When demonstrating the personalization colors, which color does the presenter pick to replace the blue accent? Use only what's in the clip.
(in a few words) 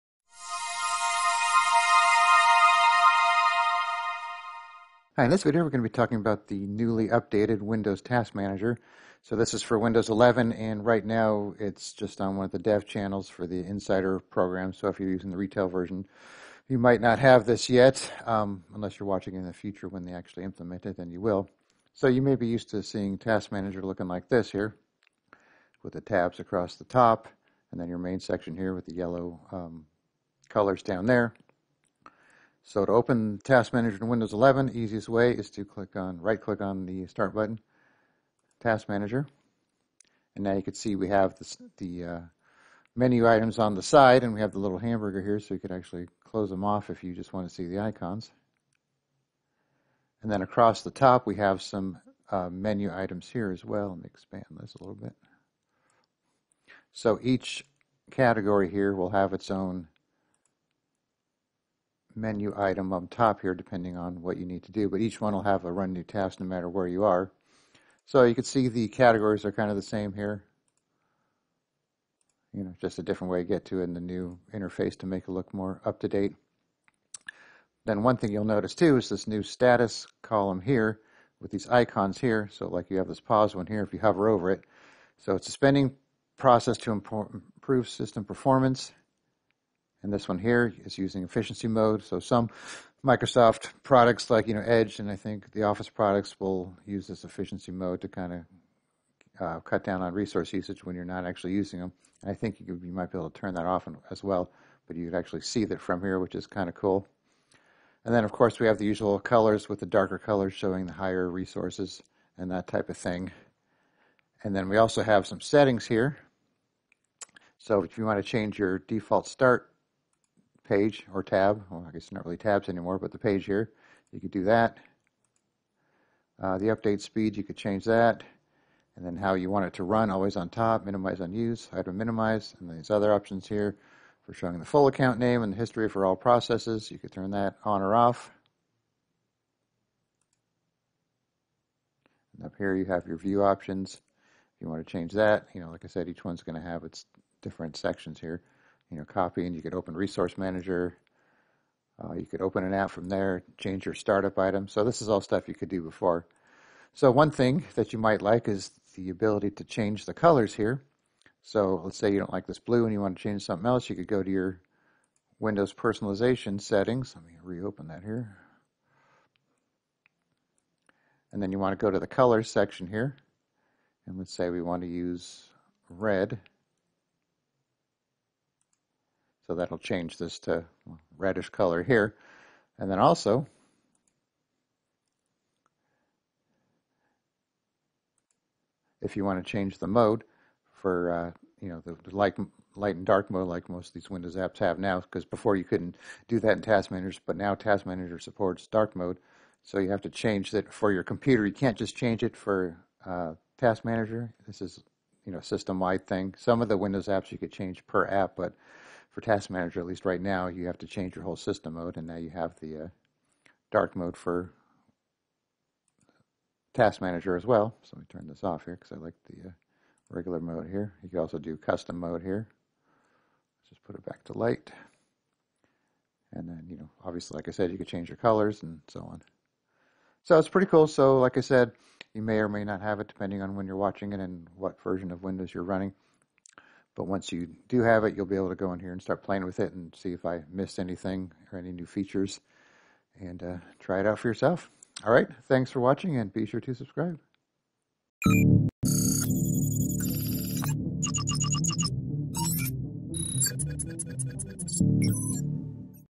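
Red.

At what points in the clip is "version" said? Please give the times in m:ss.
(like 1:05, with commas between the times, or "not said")
0:15, 3:54.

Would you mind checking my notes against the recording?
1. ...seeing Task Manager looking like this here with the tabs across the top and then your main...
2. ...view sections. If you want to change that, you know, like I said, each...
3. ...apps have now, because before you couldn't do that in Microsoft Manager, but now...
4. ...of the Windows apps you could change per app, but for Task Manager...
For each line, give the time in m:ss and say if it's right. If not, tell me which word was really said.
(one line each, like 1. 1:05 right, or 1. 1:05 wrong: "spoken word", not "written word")
1. 0:22 right
2. 2:23 wrong: "options", not "sections"
3. 3:14 wrong: "Task", not "Microsoft"
4. 3:26 right.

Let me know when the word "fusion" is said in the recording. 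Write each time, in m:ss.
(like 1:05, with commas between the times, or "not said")
not said.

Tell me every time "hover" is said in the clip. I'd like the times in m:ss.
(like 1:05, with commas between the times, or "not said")
1:23.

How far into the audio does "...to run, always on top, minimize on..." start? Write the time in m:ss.
2:09.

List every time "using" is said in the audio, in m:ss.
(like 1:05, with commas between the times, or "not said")
0:15, 1:30, 1:41.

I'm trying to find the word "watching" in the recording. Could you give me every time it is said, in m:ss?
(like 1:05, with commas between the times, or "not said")
0:19, 3:53, 4:05.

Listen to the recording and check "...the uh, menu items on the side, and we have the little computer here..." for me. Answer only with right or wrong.
wrong.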